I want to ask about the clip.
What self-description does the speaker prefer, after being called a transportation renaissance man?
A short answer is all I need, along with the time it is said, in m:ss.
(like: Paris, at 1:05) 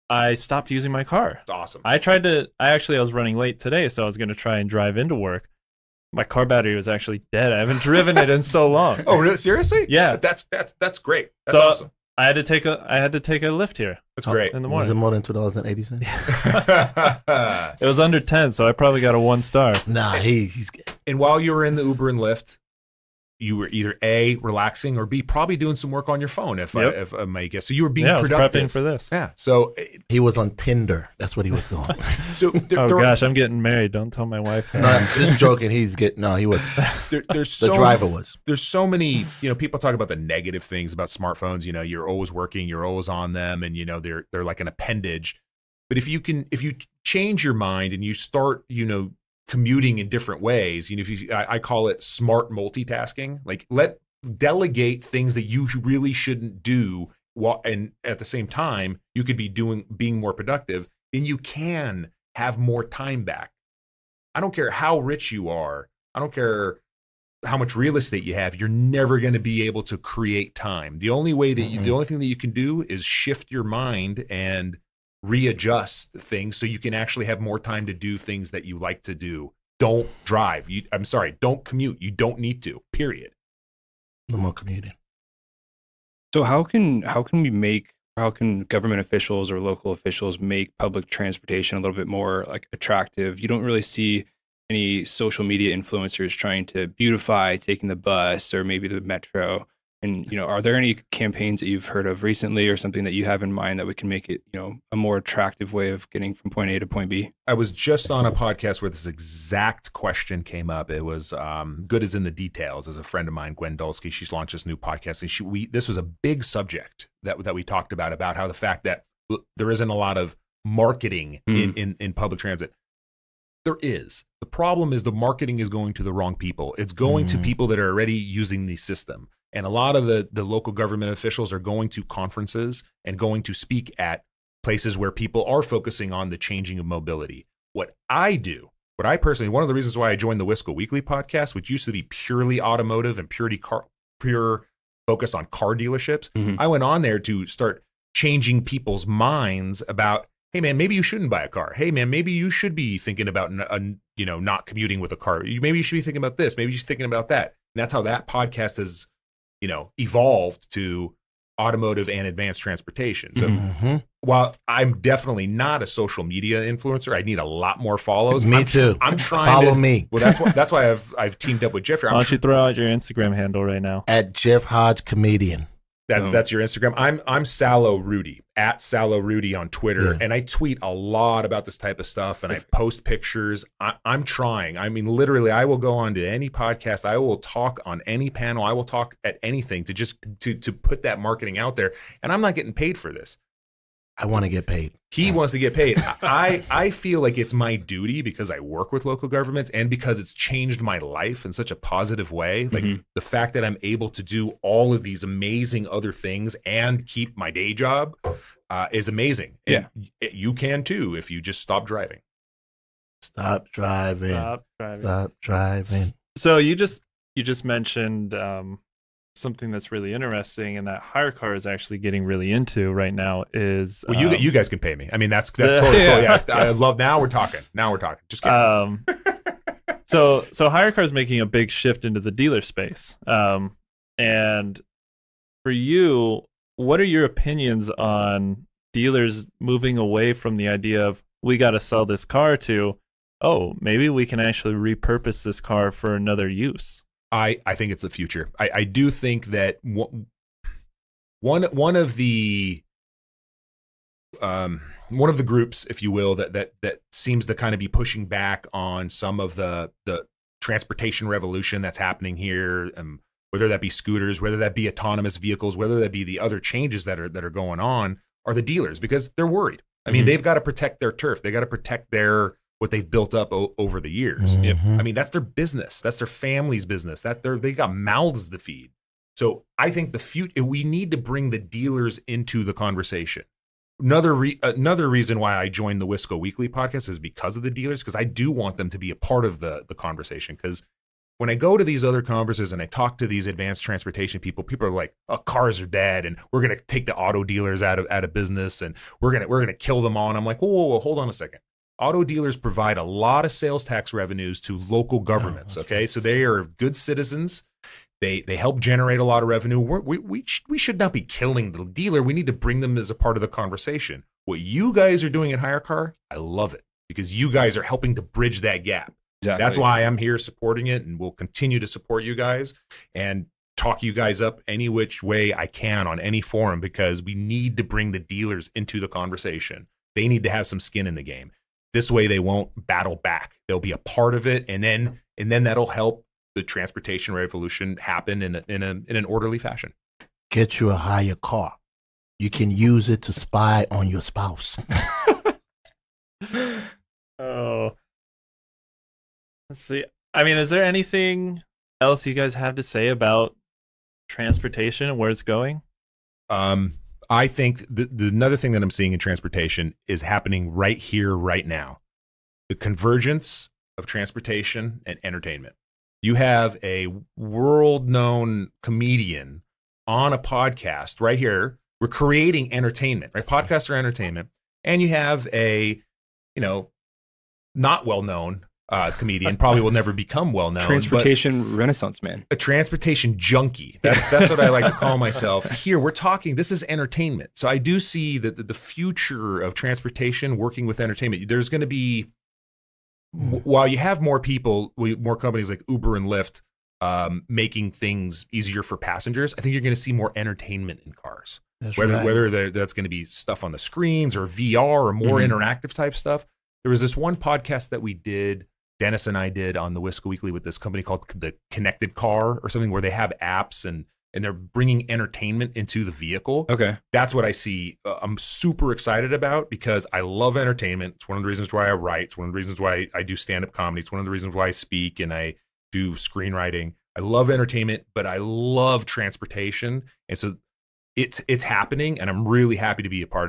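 transportation junkie, at 6:22.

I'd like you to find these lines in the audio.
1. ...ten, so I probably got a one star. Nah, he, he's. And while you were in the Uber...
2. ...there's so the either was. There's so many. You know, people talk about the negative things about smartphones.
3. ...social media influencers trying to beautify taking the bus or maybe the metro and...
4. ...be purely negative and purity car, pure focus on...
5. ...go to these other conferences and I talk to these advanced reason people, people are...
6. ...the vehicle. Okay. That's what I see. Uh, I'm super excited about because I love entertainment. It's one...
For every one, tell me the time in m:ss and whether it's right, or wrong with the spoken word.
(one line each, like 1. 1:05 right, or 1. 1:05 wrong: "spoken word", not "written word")
1. 0:18 right
2. 0:37 wrong: "driver", not "either"
3. 1:35 right
4. 2:21 wrong: "automotive", not "negative"
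5. 4:51 wrong: "transportation", not "reason"
6. 6:56 right.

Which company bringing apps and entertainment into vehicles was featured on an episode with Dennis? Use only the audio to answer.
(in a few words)
the Connected Car.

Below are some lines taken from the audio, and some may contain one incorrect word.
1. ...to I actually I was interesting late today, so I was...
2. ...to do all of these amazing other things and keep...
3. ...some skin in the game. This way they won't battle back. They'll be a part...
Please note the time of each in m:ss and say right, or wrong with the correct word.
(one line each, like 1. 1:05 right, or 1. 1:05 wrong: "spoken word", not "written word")
1. 0:02 wrong: "running", not "interesting"
2. 3:24 right
3. 5:30 right.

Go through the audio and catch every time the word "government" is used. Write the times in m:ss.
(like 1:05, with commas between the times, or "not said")
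1:28, 2:10, 3:19, 5:05.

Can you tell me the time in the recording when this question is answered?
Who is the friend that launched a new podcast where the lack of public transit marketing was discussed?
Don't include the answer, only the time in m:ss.
1:53.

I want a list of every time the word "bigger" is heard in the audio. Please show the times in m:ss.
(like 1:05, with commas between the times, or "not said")
not said.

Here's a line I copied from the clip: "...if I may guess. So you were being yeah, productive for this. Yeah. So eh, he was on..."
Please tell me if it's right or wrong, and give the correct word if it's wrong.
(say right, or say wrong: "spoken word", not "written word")
right.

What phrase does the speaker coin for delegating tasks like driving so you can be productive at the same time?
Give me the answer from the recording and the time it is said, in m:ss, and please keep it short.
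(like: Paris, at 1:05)
smart multitasking, at 0:52.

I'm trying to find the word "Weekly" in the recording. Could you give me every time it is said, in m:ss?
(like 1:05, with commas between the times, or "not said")
2:20, 4:46, 6:50.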